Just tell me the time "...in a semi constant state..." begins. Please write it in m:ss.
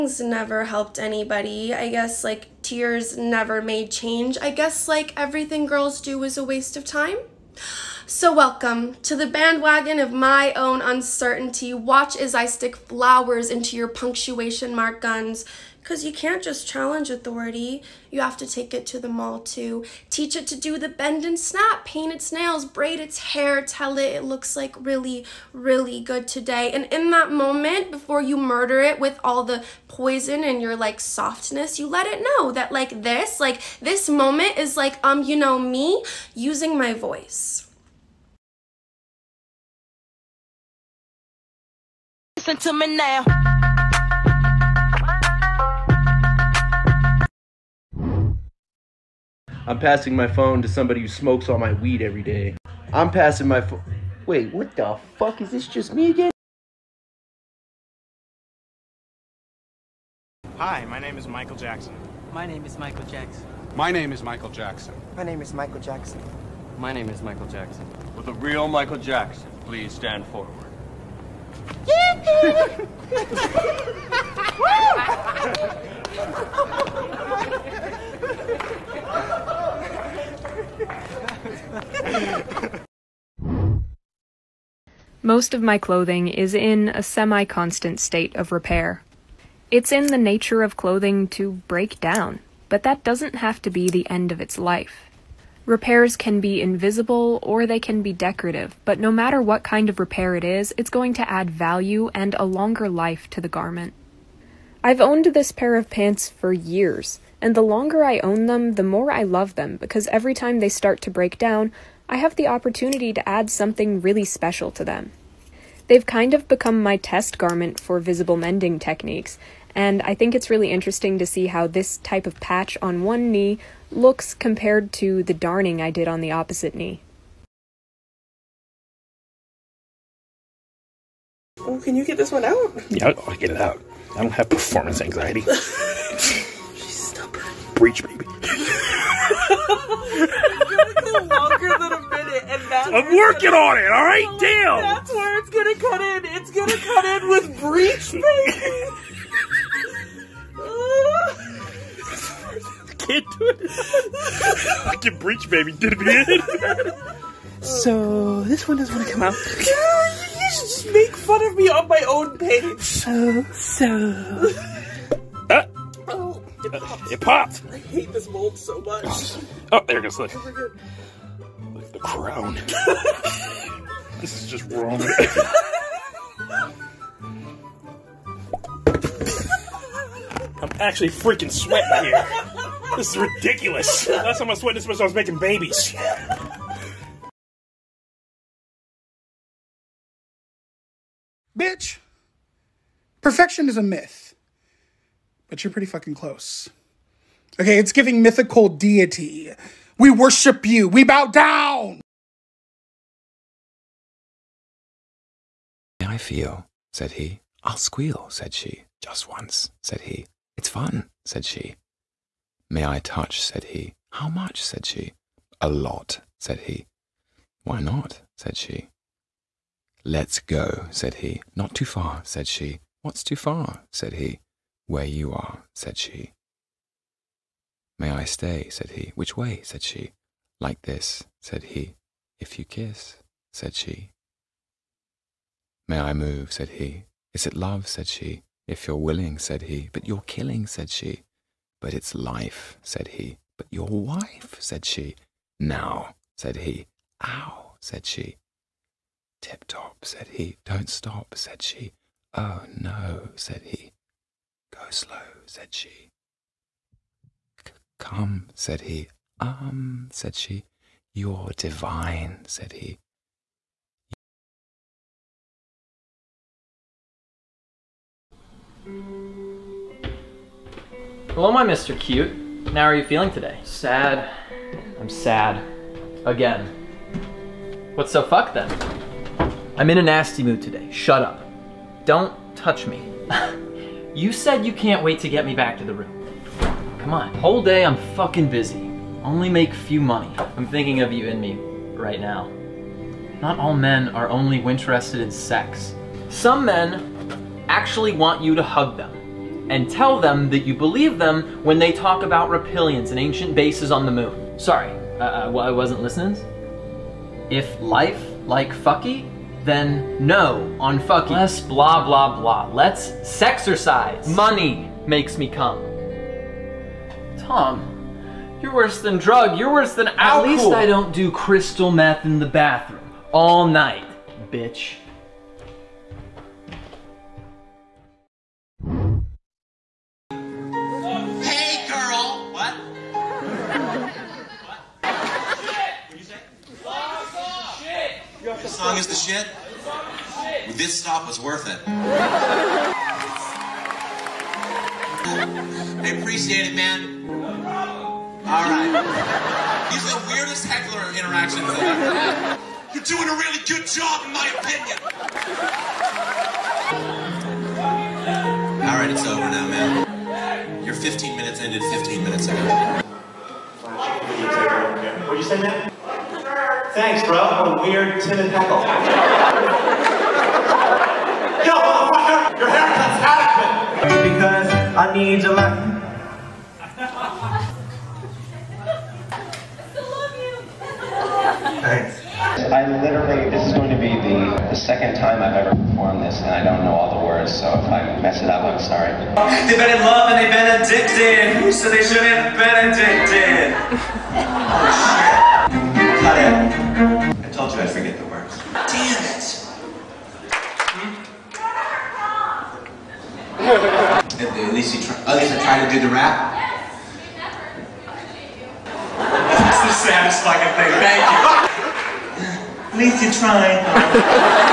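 1:26.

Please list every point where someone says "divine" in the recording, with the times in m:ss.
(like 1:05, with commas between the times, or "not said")
4:21.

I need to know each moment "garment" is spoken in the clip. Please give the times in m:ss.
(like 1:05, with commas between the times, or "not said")
1:43, 1:57.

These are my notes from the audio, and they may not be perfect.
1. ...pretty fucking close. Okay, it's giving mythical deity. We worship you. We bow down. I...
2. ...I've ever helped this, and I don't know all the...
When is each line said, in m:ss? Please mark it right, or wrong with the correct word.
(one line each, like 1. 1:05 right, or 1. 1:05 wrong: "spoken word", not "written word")
1. 3:15 right
2. 6:25 wrong: "performed", not "helped".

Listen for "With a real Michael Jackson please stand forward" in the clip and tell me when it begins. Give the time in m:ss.
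1:08.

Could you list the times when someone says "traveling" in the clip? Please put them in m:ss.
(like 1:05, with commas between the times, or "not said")
not said.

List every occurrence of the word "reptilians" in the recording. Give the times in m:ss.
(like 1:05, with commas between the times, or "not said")
5:02.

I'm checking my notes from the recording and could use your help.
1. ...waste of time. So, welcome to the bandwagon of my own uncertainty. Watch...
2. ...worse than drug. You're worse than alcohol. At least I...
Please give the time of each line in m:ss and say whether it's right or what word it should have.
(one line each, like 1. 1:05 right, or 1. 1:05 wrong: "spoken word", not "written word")
1. 0:06 right
2. 5:18 right.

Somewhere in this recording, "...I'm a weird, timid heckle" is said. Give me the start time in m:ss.
6:07.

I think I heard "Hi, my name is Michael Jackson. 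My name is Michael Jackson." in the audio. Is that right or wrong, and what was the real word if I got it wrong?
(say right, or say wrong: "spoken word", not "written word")
right.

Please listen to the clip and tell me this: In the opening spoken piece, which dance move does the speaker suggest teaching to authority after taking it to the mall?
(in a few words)
bend and snap.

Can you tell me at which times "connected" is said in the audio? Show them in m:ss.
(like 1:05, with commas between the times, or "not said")
not said.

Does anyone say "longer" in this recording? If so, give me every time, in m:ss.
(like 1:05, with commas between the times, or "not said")
1:42, 1:47.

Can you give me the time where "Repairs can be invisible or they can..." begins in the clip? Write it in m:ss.
1:35.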